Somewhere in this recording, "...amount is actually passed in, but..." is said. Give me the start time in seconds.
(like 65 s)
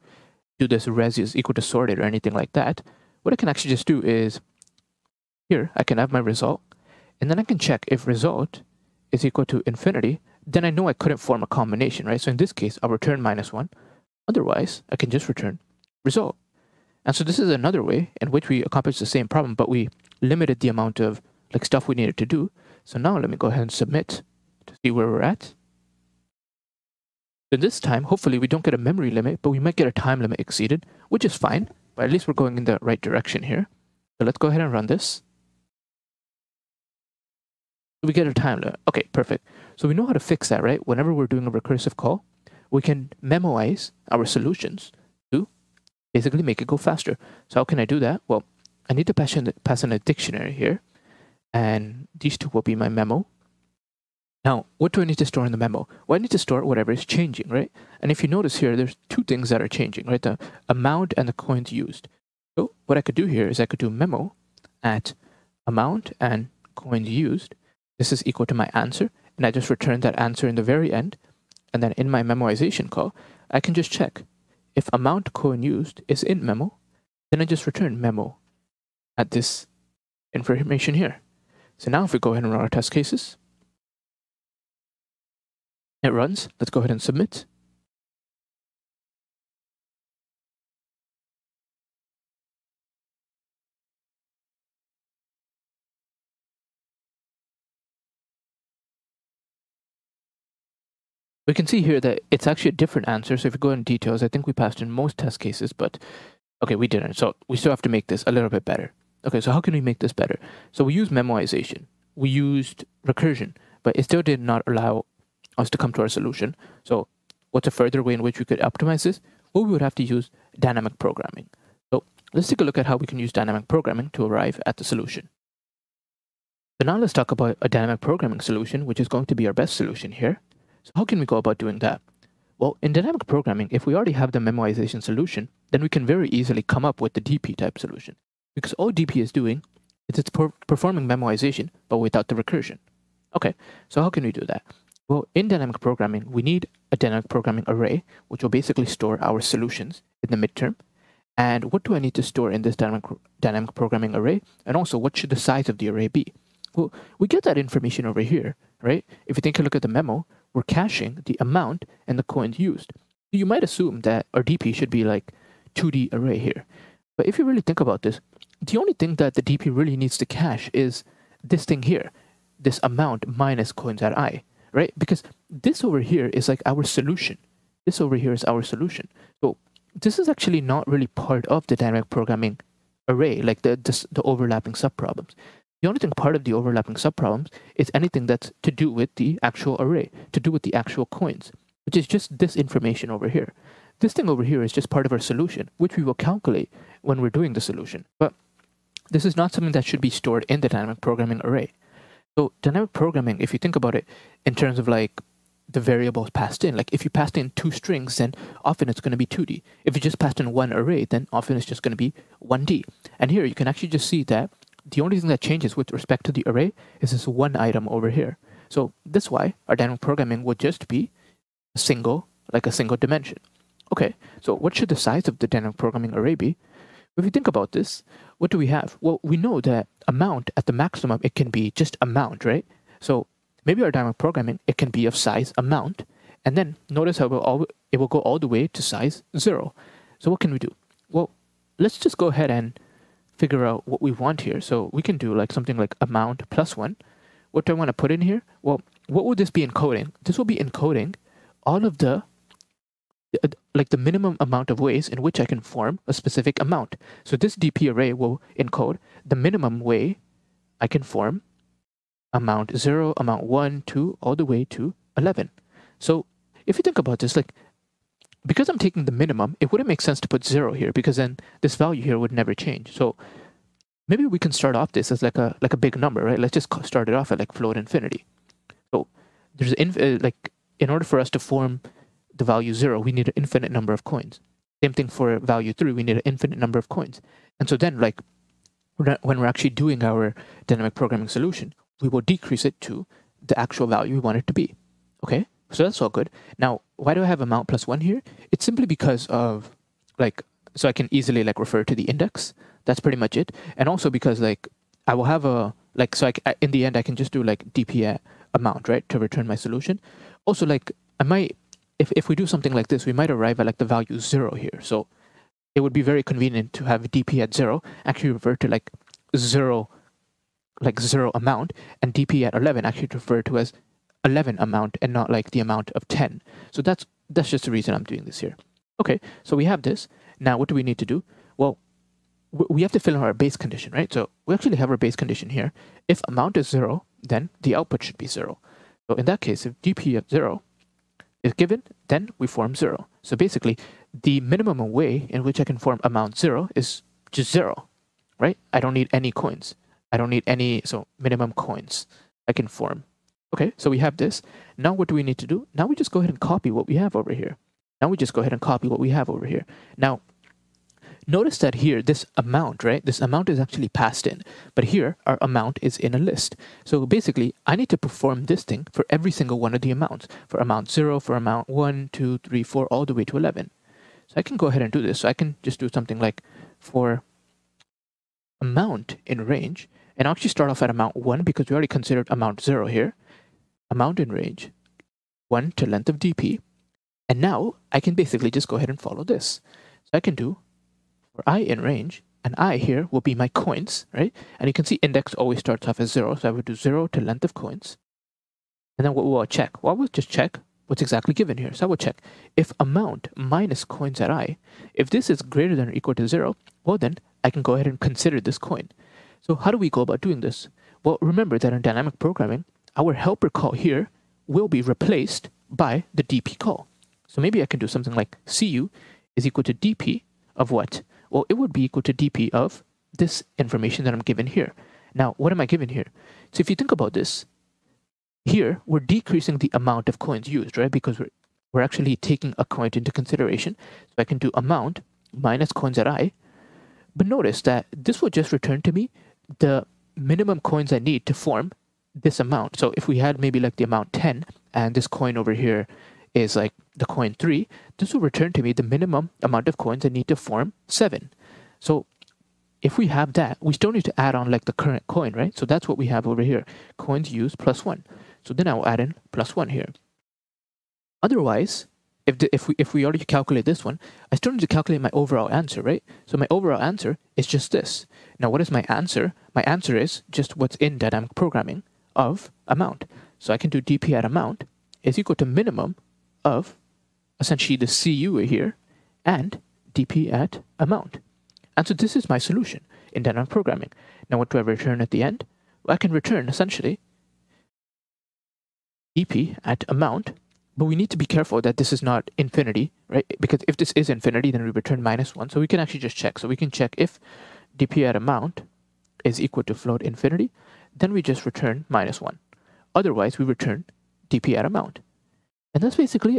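363 s.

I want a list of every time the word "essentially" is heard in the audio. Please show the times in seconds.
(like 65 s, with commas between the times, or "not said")
477 s, 486 s.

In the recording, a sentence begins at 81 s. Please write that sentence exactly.
So now if we go ahead and run our test cases, it runs.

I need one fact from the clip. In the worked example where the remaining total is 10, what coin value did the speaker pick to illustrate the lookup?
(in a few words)
3.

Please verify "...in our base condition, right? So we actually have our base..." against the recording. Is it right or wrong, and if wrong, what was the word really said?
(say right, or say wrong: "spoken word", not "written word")
right.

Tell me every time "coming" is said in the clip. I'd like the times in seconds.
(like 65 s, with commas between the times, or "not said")
not said.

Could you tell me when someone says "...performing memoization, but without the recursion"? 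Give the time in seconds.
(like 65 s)
140 s.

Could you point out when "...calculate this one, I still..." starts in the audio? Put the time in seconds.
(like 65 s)
463 s.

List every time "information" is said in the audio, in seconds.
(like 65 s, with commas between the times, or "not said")
80 s, 157 s, 192 s, 423 s.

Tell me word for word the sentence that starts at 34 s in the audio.
So let's go ahead and run this.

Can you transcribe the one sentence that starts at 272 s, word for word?
So maybe we can start off this as like a like a big number, right?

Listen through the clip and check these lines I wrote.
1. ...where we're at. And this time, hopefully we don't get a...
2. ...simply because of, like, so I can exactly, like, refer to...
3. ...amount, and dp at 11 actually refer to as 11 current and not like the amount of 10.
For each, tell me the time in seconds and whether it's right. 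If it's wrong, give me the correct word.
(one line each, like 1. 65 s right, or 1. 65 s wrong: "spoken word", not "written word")
1. 24 s right
2. 298 s wrong: "easily", not "exactly"
3. 321 s wrong: "amount", not "current".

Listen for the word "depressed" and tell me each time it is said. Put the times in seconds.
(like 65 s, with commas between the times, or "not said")
not said.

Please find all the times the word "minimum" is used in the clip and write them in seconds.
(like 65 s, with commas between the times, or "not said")
253 s, 259 s, 269 s, 344 s, 351 s, 440 s, 448 s, 475 s.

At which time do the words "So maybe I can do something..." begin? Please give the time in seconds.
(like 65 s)
417 s.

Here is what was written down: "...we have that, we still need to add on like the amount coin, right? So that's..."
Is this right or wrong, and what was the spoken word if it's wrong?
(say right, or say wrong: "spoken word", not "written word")
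wrong: "current", not "amount".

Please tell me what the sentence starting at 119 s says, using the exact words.
Well, we would have to use dynamic programming.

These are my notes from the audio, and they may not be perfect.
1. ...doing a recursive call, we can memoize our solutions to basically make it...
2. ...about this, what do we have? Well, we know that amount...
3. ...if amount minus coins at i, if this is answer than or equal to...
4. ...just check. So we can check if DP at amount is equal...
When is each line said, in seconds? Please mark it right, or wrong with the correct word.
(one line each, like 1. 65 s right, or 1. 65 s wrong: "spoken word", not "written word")
1. 41 s right
2. 227 s right
3. 402 s wrong: "greater", not "answer"
4. 496 s right.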